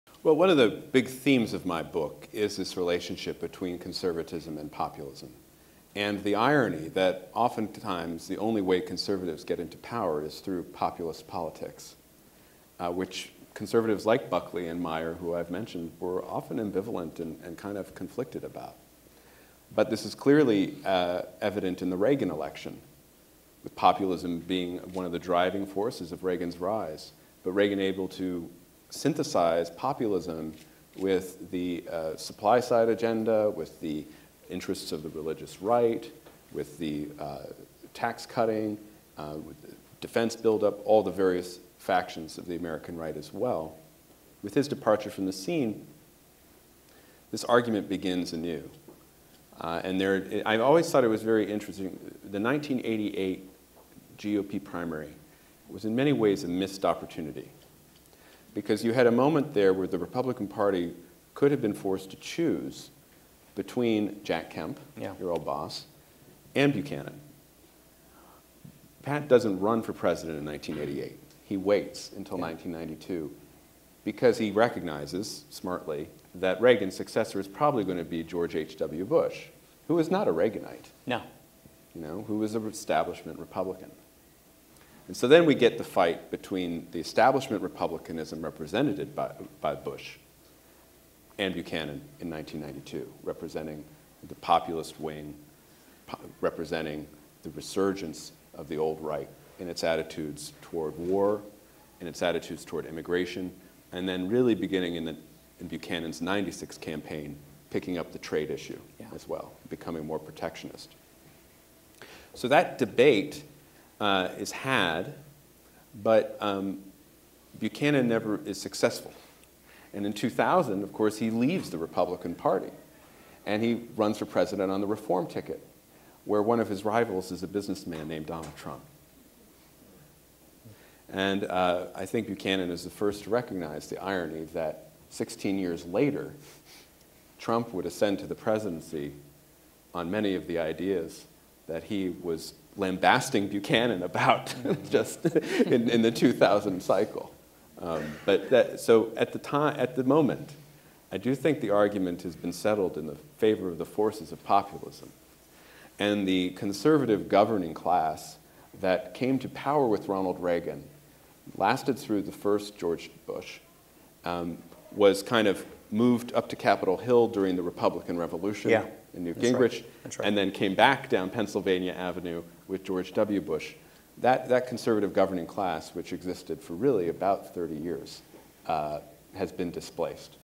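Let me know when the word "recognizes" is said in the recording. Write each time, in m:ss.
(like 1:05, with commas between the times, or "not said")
1:14, 2:13.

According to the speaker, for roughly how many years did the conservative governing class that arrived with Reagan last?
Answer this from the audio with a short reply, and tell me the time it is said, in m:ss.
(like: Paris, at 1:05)
30 years, at 2:57.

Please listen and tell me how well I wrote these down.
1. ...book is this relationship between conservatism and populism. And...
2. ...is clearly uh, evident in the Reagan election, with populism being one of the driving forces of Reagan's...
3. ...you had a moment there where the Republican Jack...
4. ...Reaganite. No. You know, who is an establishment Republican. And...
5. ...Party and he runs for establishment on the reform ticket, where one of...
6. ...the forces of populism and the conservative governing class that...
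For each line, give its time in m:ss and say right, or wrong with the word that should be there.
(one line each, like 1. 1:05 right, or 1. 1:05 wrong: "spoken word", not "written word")
1. 0:01 right
2. 0:20 right
3. 0:58 wrong: "Party", not "Jack"
4. 1:20 right
5. 2:02 wrong: "president", not "establishment"
6. 2:33 right.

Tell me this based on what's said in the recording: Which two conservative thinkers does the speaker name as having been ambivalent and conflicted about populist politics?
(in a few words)
Buckley and Meyer.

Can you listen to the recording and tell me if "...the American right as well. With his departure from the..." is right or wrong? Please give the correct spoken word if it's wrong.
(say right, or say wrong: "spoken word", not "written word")
right.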